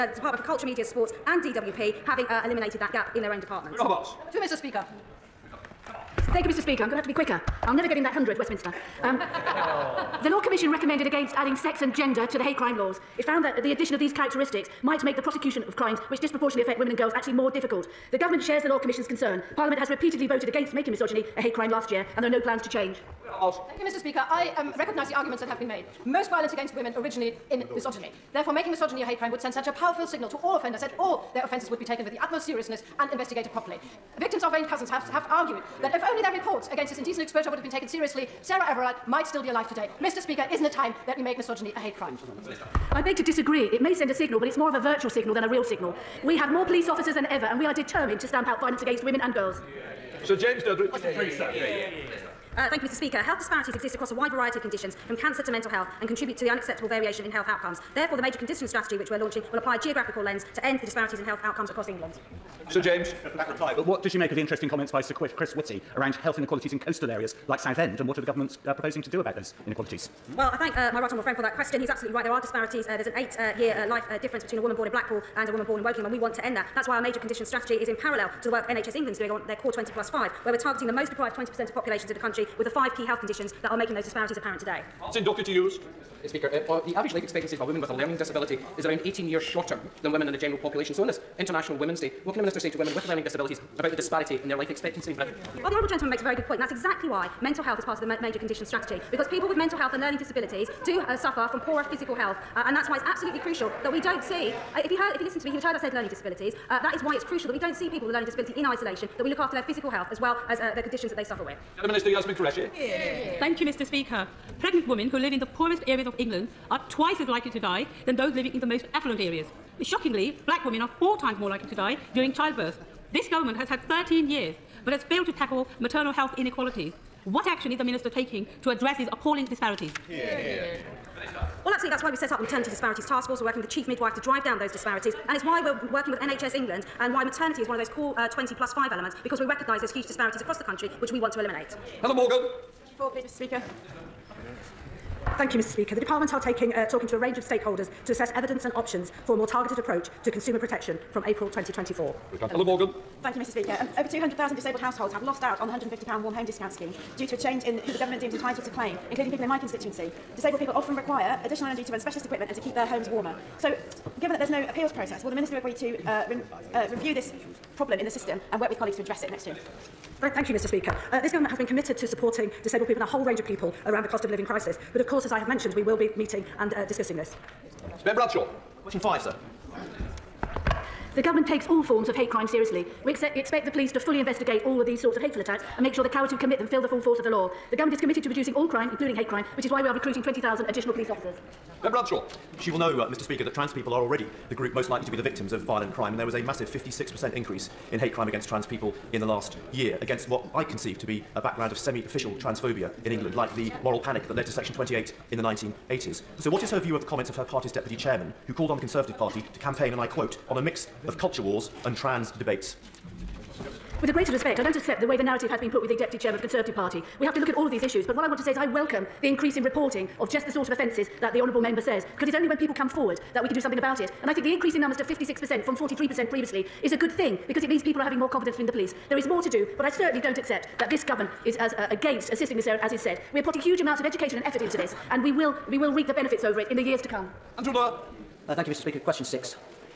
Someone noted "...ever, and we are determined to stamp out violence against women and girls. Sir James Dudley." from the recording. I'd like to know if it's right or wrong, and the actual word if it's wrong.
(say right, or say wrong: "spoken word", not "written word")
right.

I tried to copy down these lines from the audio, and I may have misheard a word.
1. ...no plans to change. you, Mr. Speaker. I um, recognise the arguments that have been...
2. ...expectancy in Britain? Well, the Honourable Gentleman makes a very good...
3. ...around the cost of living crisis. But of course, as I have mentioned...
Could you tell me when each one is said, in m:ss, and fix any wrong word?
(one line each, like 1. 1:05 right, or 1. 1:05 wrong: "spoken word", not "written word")
1. 0:22 right
2. 1:34 right
3. 2:53 right.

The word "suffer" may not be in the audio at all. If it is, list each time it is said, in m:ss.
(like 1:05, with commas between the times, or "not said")
1:41, 1:51.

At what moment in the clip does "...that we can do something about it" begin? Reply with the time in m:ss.
3:43.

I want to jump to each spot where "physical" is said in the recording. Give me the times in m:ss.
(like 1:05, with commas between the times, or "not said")
1:41, 1:49.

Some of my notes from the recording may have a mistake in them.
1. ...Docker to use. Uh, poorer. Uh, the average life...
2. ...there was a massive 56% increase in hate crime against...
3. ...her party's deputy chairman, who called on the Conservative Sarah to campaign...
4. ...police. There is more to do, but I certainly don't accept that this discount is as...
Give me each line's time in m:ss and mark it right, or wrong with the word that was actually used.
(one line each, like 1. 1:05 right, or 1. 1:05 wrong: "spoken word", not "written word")
1. 1:25 wrong: "speaker", not "poorer"
2. 3:16 right
3. 3:27 wrong: "Party", not "Sarah"
4. 3:48 wrong: "government", not "discount".